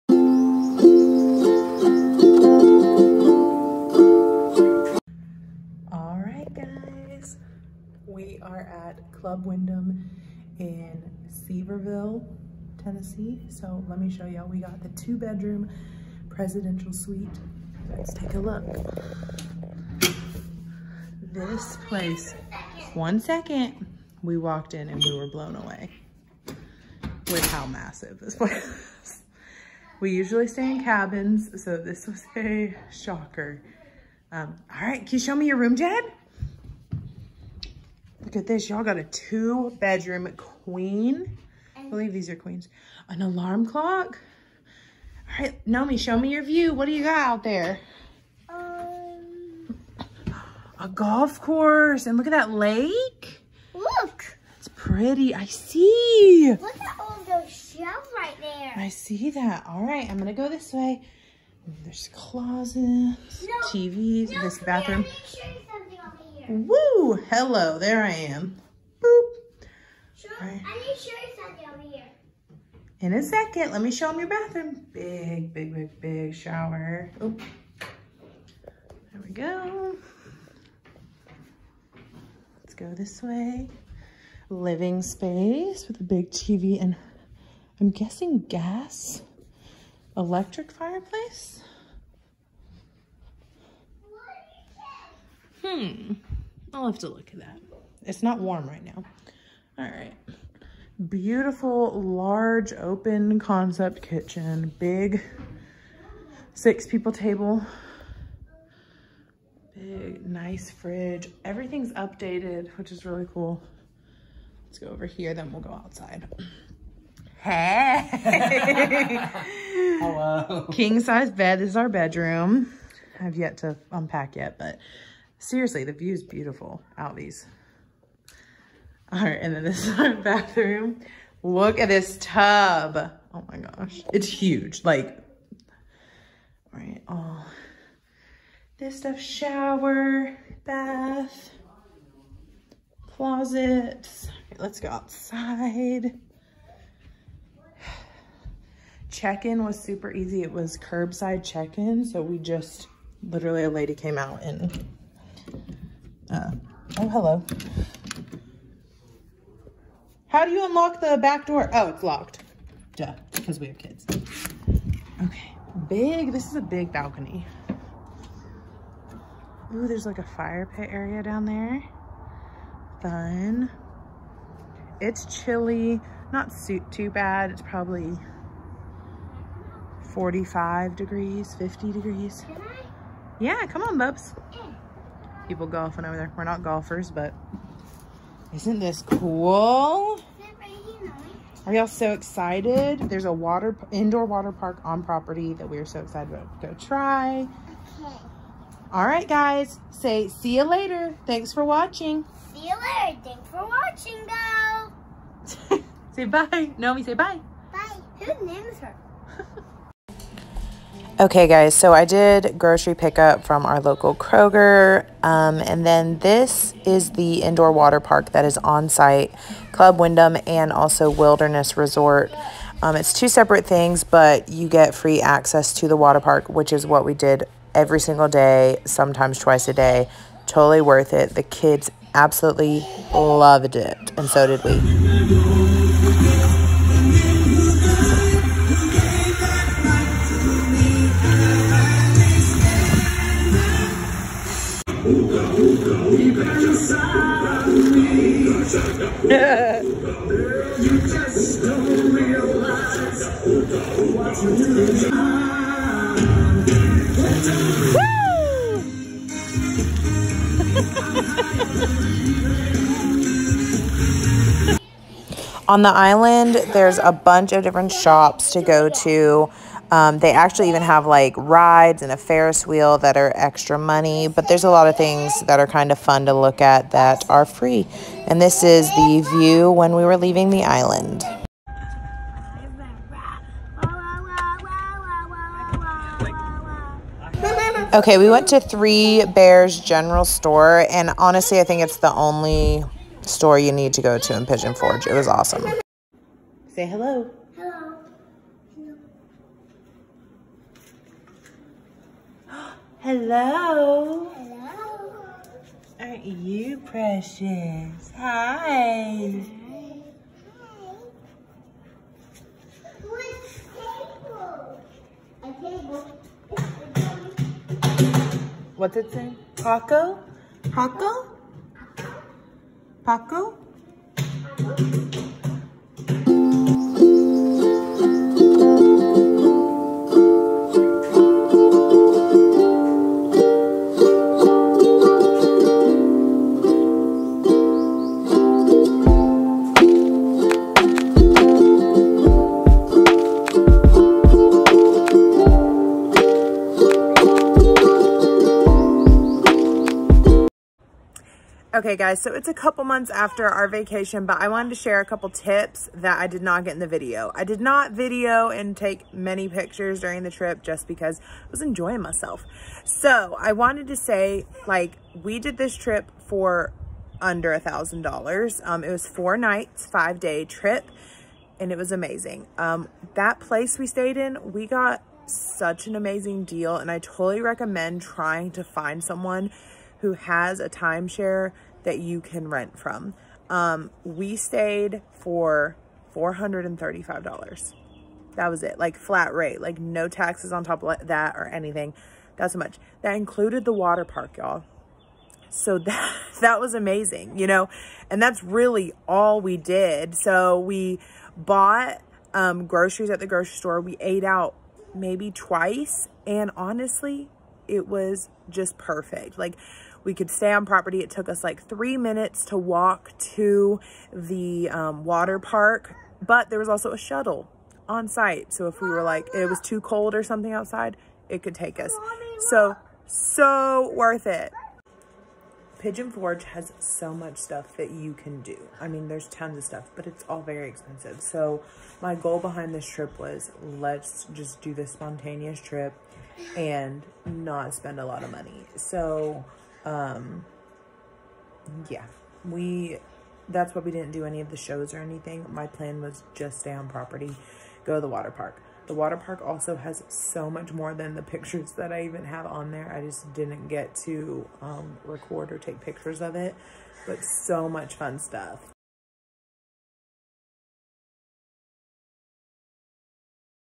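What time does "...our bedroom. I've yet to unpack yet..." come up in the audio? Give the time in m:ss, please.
2:01.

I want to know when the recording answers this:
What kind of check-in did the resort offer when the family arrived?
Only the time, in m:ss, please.
2:30.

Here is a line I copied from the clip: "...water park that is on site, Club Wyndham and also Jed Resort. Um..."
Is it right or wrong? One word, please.
wrong.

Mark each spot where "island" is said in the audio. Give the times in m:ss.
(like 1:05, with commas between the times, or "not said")
4:25, 4:40.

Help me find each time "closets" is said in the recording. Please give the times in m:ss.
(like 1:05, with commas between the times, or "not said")
1:02, 2:23.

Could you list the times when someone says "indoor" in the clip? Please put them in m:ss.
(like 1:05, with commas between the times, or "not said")
3:13, 3:37.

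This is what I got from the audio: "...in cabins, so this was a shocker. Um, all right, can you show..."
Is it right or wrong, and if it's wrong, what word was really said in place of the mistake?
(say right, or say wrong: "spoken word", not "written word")
right.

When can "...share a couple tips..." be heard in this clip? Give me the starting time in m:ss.
5:54.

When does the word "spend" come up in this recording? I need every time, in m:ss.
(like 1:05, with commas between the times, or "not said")
7:17.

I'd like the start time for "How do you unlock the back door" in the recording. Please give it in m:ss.
2:40.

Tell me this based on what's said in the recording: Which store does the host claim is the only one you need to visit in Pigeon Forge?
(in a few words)
Three Bears General Store.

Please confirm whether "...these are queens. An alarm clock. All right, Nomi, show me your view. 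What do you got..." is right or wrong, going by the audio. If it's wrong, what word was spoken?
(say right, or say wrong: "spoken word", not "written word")
right.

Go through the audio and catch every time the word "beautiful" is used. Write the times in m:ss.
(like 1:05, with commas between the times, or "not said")
1:41, 2:06.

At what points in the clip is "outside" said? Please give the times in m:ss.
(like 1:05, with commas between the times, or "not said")
1:55, 2:24, 7:00.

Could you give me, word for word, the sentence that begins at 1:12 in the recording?
In a second, let me show them your bathroom.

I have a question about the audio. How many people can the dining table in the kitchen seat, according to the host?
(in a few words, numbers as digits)
6.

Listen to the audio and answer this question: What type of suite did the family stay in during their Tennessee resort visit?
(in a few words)
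Two bedroom presidential suite.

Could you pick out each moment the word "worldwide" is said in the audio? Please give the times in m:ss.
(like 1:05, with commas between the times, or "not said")
not said.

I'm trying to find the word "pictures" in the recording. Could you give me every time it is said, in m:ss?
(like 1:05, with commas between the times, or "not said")
5:59, 7:31, 7:35.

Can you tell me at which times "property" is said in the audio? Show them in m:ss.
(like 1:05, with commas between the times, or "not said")
3:15, 6:50, 7:26.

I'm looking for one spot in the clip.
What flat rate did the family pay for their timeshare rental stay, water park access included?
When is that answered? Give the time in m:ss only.
6:26.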